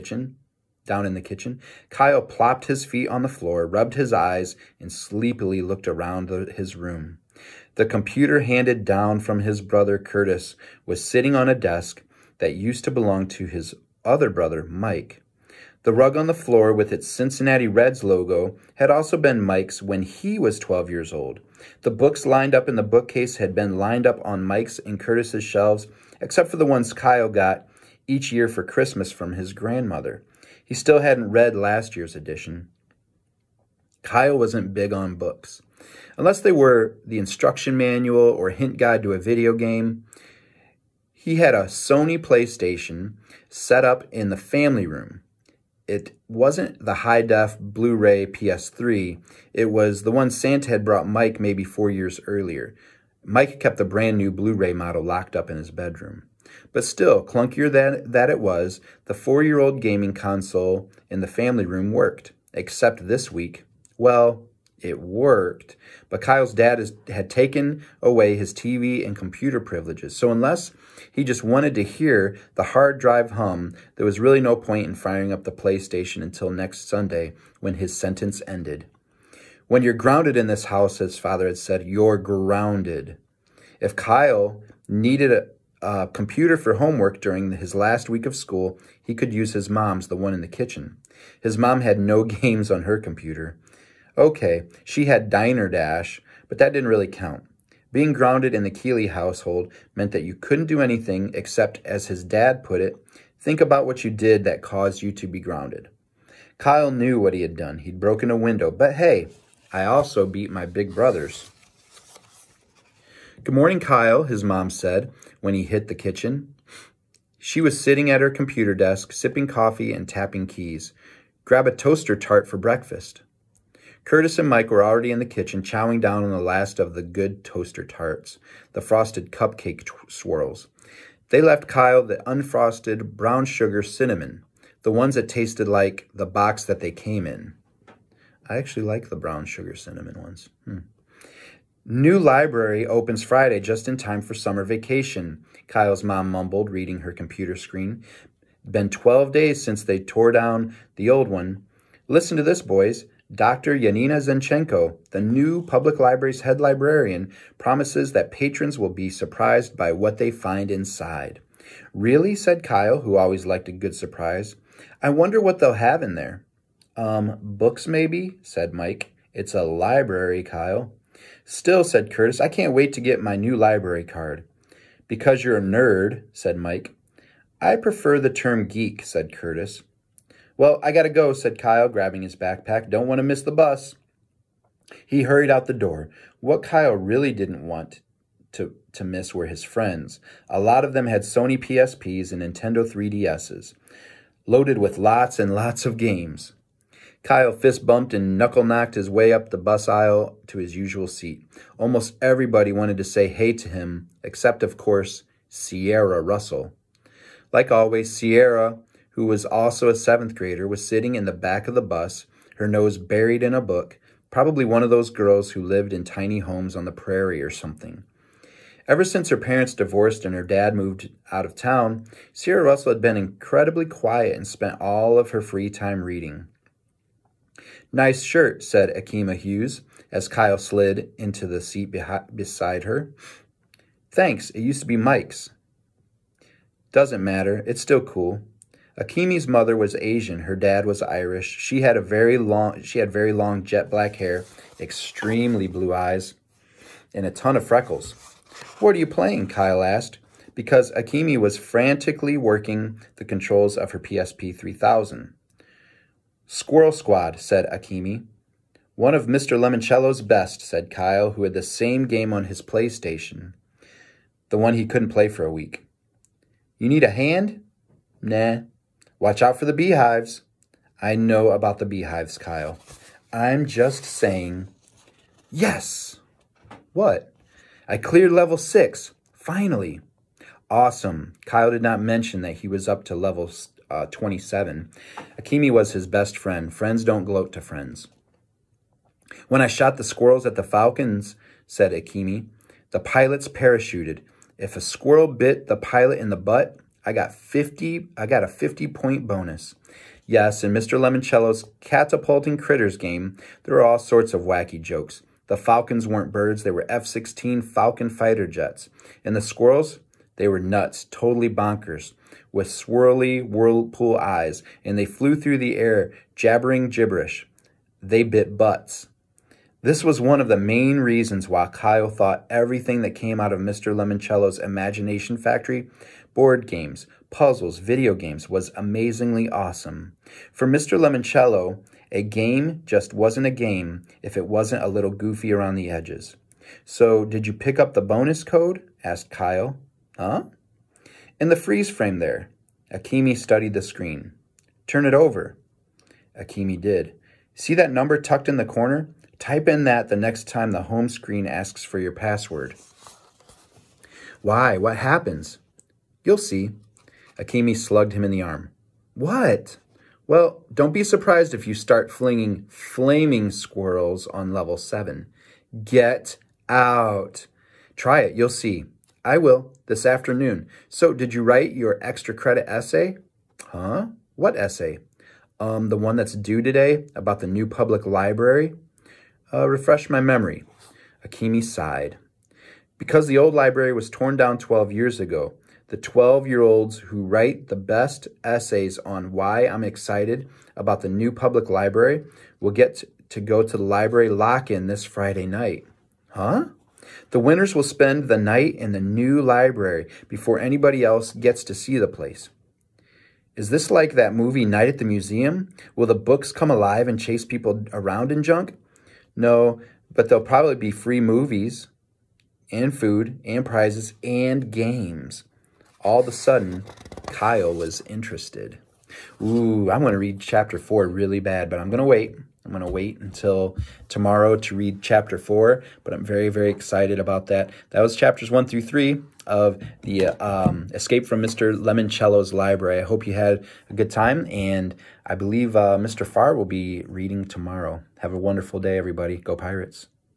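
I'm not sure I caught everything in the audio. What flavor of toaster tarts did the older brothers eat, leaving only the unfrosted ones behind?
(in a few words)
frosted cupcake swirls.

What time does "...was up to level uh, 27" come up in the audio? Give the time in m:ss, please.
4:42.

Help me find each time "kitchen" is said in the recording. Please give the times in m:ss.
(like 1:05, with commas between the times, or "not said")
0:01, 1:30, 1:55, 2:05.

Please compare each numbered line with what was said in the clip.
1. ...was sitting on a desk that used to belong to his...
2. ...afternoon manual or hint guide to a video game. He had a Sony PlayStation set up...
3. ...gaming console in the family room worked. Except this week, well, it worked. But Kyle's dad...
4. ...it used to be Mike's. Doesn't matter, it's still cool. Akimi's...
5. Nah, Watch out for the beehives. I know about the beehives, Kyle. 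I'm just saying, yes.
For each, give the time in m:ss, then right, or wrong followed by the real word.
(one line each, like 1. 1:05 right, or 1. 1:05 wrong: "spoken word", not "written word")
1. 0:10 right
2. 0:37 wrong: "instruction", not "afternoon"
3. 0:59 right
4. 3:54 right
5. 4:28 right.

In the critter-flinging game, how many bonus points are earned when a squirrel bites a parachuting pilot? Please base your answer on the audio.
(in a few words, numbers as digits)
50.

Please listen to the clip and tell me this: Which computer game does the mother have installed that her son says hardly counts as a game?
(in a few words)
Diner Dash.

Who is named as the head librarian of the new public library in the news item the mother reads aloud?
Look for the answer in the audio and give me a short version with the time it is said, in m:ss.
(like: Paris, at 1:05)
Dr. Yanina Zinchenko, at 2:33.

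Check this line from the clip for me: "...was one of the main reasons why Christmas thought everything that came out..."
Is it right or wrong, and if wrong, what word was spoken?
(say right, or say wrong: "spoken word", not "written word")
wrong: "Kyle", not "Christmas".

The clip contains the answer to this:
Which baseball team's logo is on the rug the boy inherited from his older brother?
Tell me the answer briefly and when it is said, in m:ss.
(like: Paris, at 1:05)
Cincinnati Reds, at 0:17.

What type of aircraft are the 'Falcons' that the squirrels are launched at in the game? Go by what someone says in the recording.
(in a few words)
F-16 fighter jets.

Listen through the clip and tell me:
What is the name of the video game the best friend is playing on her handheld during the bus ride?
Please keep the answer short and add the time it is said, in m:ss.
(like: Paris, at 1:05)
Squirrel Squad, at 4:16.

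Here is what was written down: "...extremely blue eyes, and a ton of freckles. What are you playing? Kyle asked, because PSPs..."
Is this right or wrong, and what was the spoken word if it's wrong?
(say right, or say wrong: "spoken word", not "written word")
wrong: "Akimi", not "PSPs".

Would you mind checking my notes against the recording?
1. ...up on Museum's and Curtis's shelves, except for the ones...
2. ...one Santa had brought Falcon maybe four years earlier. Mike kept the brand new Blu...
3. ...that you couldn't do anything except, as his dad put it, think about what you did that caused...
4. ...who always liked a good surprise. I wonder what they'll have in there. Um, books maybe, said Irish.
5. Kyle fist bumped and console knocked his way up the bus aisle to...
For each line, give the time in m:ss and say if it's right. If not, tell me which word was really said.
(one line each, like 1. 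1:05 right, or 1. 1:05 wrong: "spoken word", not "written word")
1. 0:24 wrong: "Mike", not "Museum"
2. 0:50 wrong: "Mike", not "Falcon"
3. 1:40 right
4. 2:43 wrong: "Mike", not "Irish"
5. 3:17 wrong: "knuckle", not "console".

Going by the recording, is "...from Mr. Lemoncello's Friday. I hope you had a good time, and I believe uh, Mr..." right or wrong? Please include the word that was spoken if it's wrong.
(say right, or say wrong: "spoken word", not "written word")
wrong: "Library", not "Friday".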